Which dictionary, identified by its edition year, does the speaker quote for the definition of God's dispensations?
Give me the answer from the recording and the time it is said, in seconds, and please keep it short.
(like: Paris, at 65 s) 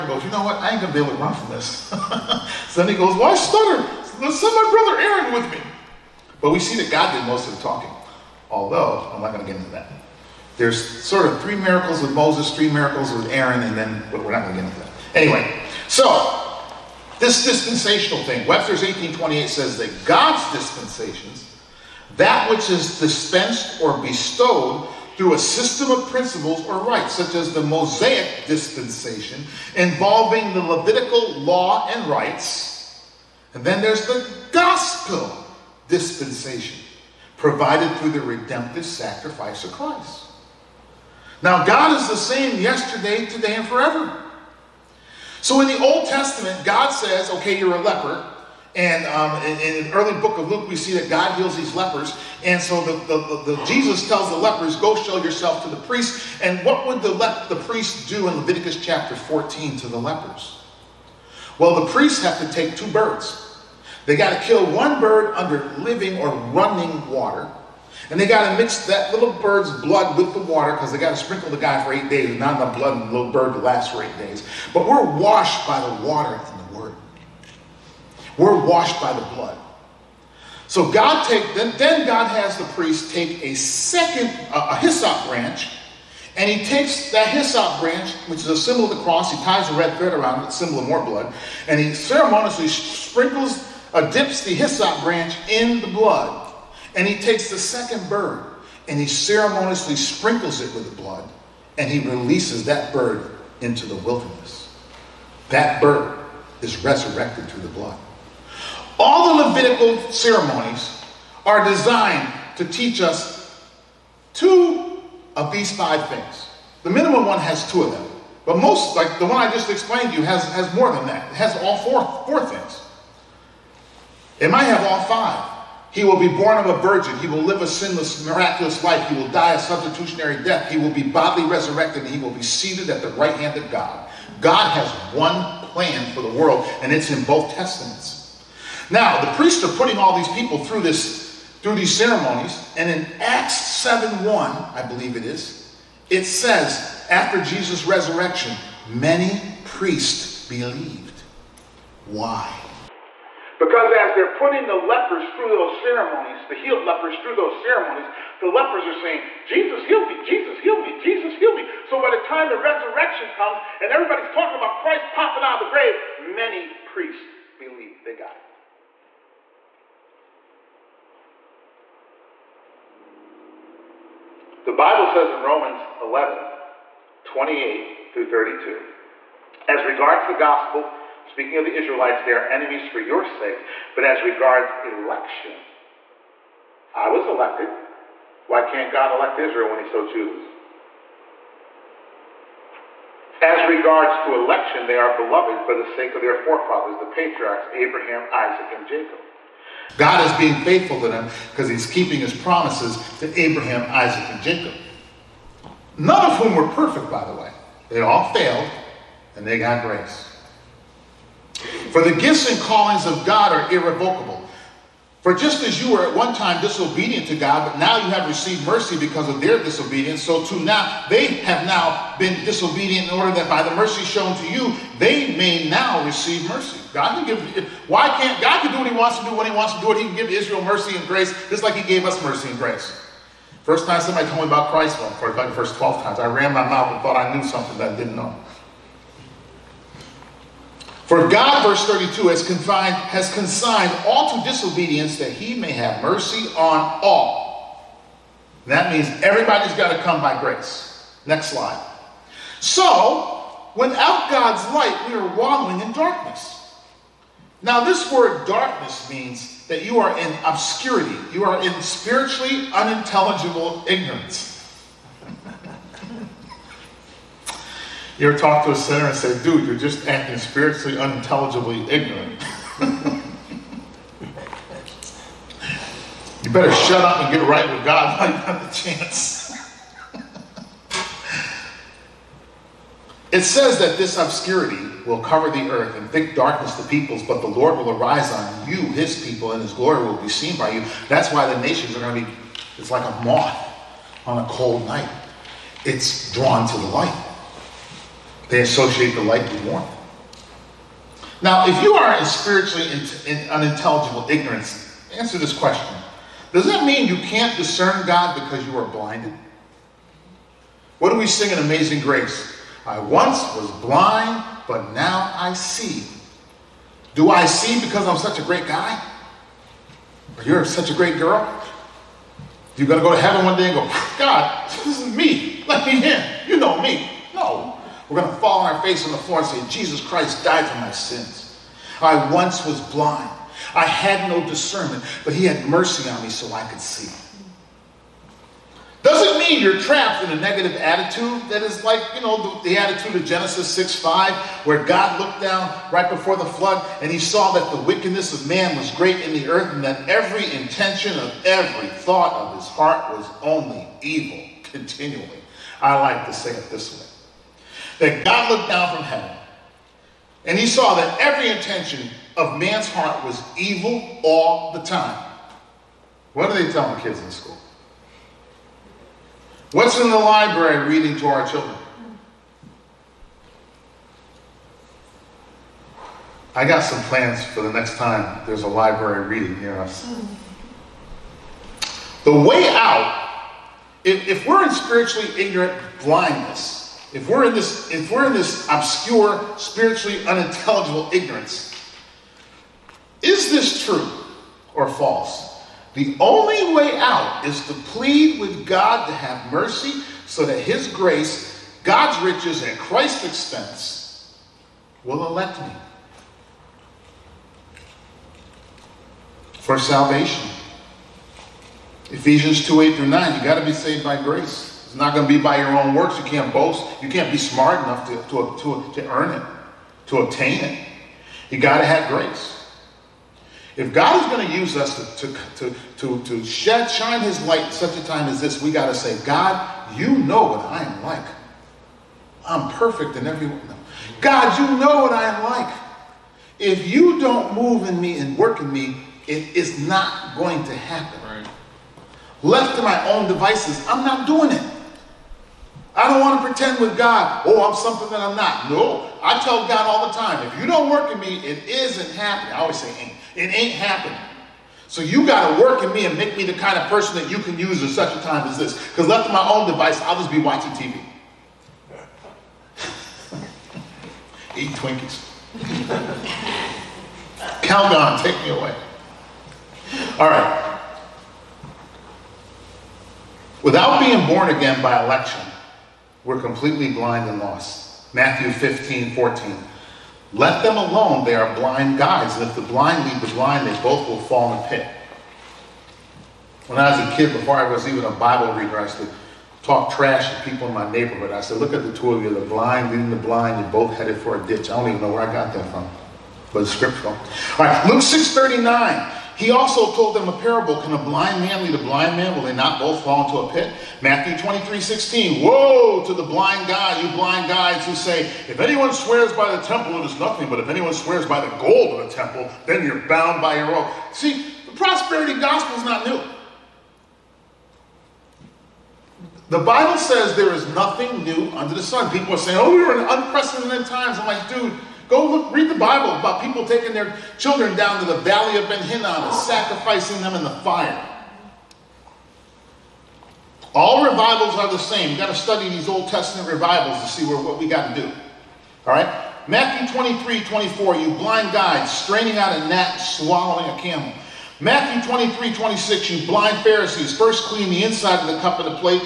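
Webster's 1828, at 18 s.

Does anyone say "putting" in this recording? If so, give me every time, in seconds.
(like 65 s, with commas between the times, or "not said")
139 s, 154 s.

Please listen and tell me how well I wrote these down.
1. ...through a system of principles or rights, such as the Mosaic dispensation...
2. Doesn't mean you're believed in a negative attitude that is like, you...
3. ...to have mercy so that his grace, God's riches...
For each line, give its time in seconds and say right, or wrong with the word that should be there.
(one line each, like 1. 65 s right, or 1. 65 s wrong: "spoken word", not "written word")
1. 25 s right
2. 339 s wrong: "trapped", not "believed"
3. 399 s right.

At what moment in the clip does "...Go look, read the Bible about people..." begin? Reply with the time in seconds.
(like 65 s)
525 s.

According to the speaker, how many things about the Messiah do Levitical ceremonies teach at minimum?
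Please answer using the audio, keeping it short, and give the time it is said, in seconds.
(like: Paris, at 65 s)
2, at 116 s.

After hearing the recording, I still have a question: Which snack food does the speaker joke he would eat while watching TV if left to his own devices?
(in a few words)
Twinkies.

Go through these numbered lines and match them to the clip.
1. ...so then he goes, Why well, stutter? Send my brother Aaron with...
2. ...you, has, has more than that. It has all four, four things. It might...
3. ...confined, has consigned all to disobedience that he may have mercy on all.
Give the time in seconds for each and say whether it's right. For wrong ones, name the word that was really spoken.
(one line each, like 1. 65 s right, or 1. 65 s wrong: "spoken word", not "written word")
1. 2 s right
2. 120 s right
3. 242 s right.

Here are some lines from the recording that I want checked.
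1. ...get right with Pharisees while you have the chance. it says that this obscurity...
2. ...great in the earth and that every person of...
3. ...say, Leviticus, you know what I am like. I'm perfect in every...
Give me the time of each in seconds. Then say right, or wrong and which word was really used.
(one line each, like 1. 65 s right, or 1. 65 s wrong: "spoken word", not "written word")
1. 277 s wrong: "God", not "Pharisees"
2. 348 s wrong: "intention", not "person"
3. 428 s wrong: "God", not "Leviticus".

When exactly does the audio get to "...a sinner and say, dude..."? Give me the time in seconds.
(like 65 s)
268 s.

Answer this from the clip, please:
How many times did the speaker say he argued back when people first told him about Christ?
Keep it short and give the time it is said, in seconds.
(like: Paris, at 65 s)
12, at 235 s.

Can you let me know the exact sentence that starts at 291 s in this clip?
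That's why the nations are going to be, it's like a moth on a cold night.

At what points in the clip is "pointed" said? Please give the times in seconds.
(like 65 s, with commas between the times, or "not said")
not said.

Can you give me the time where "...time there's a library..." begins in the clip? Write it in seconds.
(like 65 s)
377 s.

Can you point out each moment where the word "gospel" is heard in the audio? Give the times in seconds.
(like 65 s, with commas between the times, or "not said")
34 s, 180 s, 515 s.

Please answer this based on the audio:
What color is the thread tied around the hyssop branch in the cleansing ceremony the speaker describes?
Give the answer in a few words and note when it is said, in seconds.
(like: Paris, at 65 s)
Red, at 89 s.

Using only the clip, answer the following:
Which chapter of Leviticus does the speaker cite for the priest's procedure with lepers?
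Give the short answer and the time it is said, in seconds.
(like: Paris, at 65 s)
Chapter 14, at 58 s.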